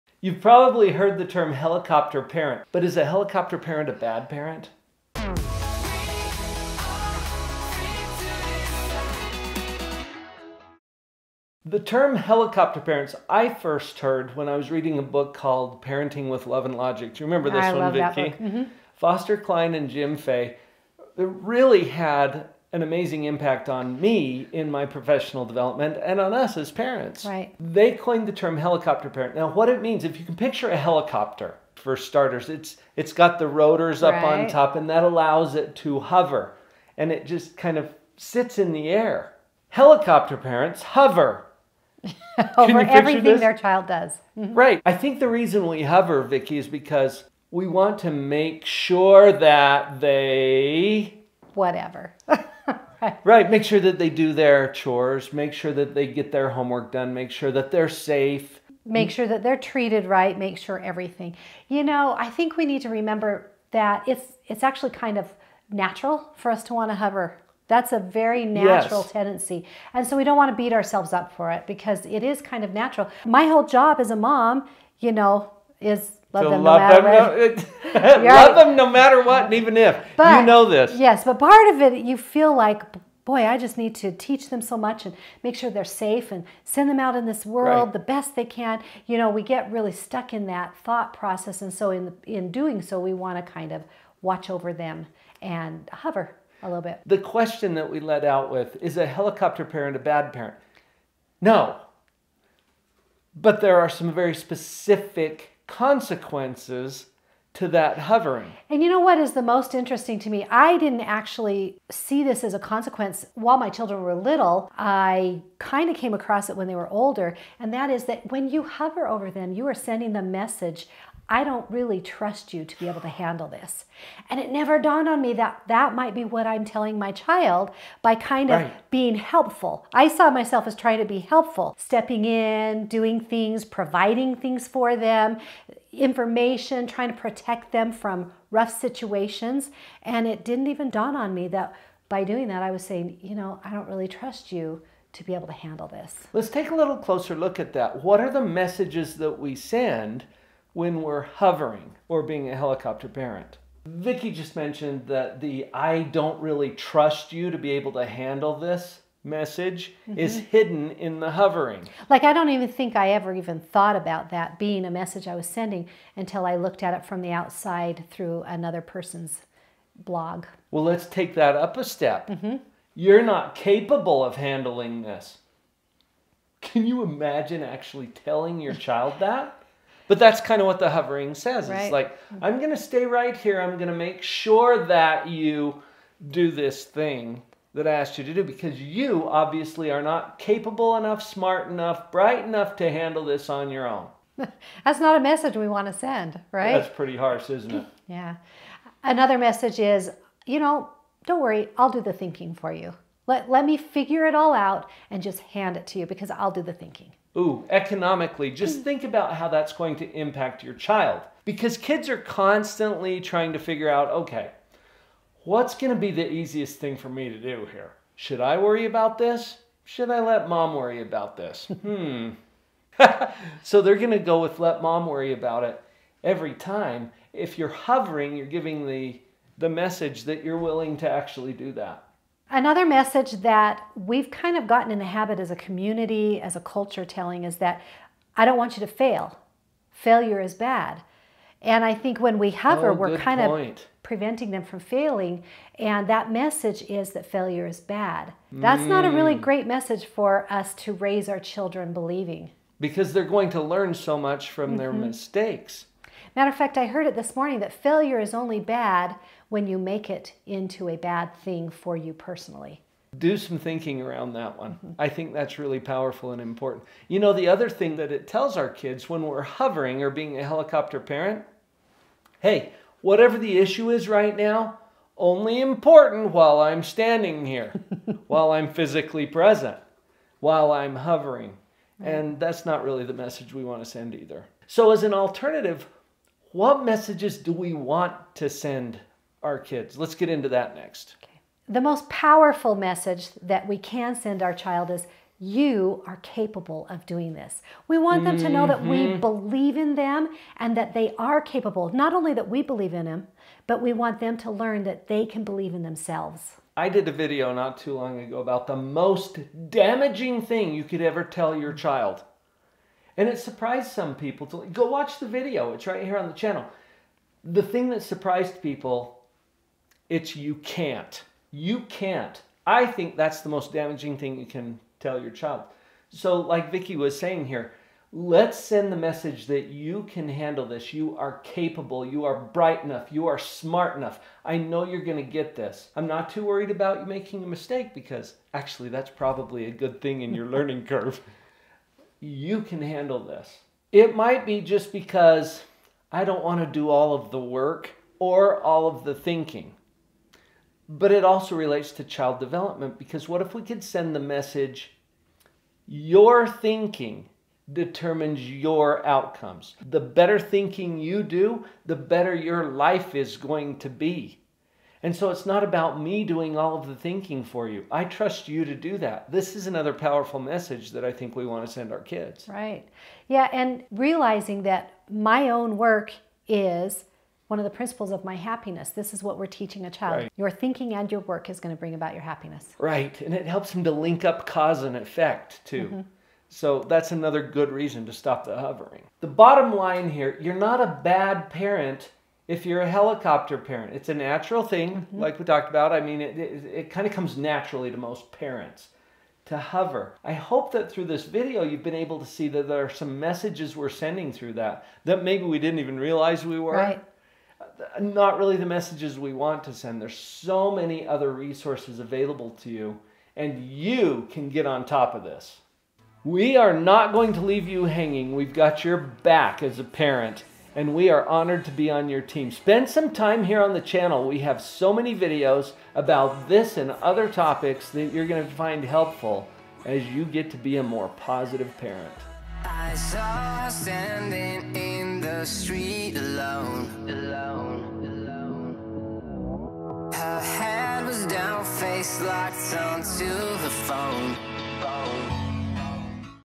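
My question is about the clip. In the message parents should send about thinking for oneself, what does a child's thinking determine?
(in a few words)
your outcomes.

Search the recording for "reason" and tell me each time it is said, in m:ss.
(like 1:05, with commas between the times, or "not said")
0:45, 6:27.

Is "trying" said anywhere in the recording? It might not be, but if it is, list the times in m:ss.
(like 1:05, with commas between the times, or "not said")
2:10, 2:16, 3:33.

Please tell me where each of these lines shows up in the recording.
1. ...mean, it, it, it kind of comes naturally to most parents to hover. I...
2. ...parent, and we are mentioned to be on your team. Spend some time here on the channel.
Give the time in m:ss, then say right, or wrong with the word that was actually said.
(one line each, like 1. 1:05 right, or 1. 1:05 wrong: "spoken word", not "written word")
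1. 6:36 right
2. 6:59 wrong: "honored", not "mentioned".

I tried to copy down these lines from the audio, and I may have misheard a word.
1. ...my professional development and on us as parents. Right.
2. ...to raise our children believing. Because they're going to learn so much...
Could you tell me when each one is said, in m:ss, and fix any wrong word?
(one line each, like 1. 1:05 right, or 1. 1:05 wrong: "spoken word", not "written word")
1. 0:24 right
2. 4:10 right.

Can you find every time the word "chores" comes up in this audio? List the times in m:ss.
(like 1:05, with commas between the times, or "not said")
0:54.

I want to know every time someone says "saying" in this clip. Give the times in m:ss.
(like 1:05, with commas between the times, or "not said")
2:22, 5:27.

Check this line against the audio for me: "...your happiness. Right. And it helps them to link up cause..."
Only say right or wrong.
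right.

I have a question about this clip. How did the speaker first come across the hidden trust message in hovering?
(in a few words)
another person's blog.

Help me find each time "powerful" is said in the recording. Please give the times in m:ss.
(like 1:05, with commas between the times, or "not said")
4:25, 4:52, 6:09.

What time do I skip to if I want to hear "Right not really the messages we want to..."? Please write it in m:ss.
6:46.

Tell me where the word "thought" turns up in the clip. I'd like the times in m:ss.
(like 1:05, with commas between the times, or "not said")
1:30, 2:43.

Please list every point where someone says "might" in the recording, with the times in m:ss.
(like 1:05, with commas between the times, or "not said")
2:05, 5:44.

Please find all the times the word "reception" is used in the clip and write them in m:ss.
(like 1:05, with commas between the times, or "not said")
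not said.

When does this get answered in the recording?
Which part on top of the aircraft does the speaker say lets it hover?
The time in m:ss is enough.
0:33.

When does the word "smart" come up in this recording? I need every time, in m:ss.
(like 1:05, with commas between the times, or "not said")
3:11, 5:33.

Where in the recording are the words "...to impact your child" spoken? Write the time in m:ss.
3:29.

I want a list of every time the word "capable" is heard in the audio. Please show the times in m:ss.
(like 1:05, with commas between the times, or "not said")
2:53, 3:10, 4:56, 5:01, 5:31.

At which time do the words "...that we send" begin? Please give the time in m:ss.
2:29.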